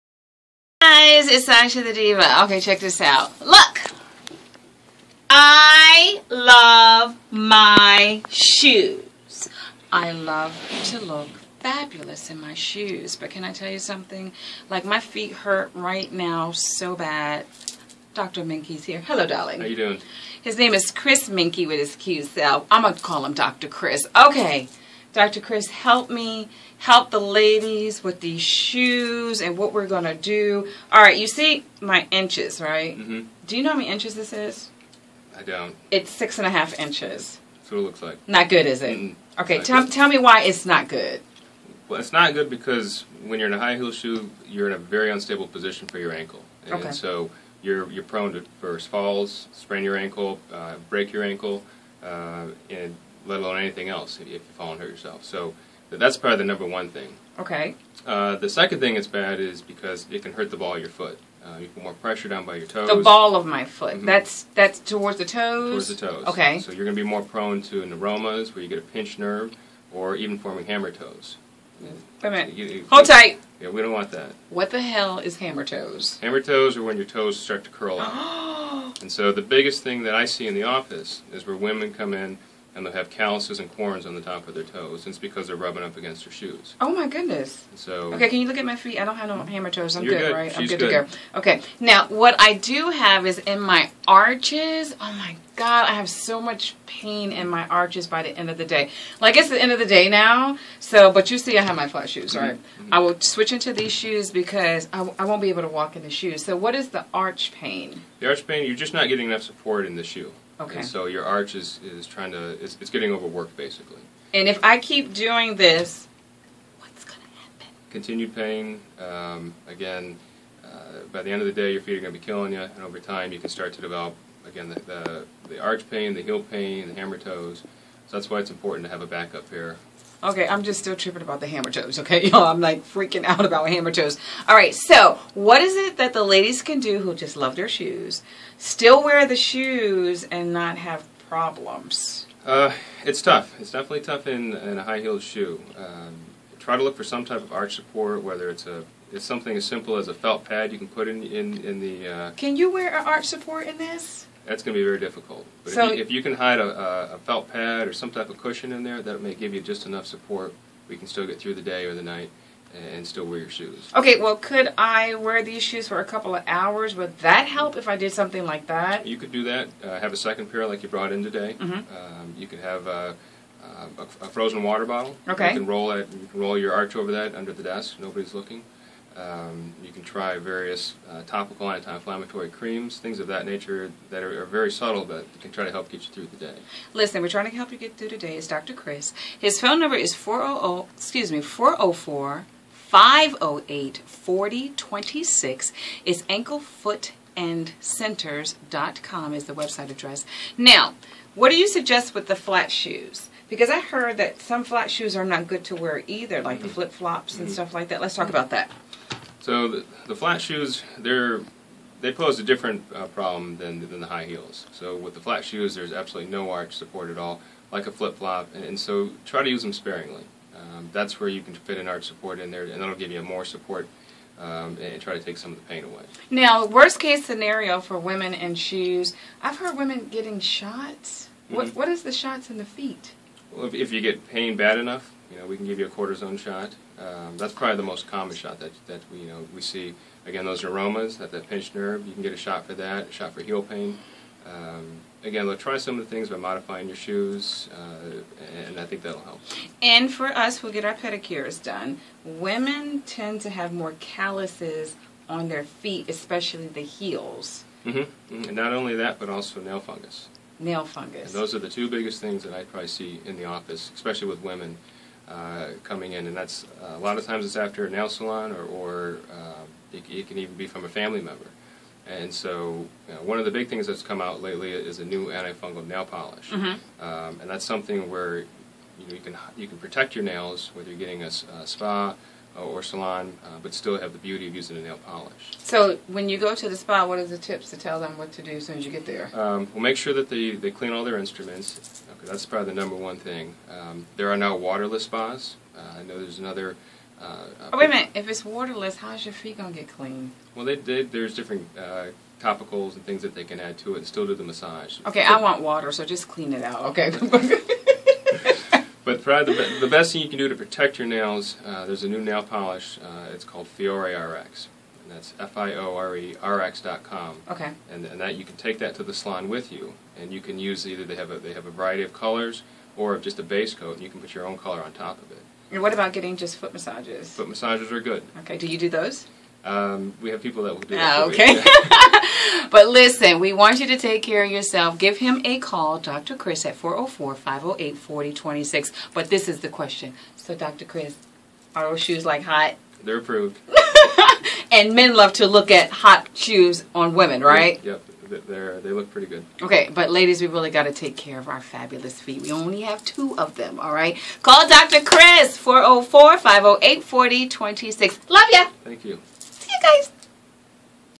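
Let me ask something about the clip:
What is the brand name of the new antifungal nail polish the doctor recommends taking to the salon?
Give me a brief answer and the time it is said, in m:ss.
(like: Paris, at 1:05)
Fiore RX, at 5:13.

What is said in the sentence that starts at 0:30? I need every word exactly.
All right, you see my inches, right?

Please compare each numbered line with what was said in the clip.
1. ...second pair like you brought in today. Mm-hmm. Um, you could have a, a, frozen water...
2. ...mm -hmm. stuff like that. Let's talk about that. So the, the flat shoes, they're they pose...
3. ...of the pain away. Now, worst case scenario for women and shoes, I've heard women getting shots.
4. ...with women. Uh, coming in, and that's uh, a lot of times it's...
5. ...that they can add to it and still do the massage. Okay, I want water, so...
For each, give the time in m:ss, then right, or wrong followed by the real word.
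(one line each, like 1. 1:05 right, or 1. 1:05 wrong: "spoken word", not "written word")
1. 2:50 right
2. 3:27 right
3. 3:45 right
4. 4:24 right
5. 5:03 right.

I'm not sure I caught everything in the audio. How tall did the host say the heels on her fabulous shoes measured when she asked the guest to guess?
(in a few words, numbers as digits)
6.5 inches.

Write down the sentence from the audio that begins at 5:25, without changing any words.
And what about getting just foot massages?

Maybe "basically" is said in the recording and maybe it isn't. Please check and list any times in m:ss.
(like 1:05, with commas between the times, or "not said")
1:53.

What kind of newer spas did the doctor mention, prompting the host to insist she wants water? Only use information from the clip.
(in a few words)
waterless spas.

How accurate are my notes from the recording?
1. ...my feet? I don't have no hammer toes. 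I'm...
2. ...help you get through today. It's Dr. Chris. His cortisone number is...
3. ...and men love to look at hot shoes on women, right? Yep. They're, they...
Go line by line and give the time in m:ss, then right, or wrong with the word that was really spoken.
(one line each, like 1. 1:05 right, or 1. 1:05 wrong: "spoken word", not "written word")
1. 1:28 right
2. 3:07 wrong: "phone", not "cortisone"
3. 5:44 right.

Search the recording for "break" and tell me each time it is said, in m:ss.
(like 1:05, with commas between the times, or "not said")
0:50.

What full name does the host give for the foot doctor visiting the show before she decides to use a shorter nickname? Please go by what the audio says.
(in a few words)
Chris Menkly.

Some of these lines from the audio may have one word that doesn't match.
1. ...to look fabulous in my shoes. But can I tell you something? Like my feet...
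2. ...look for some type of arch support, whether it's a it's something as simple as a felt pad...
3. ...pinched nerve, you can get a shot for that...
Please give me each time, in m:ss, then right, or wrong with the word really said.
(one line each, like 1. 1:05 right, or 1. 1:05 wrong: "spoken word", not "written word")
1. 0:10 right
2. 2:26 right
3. 4:01 right.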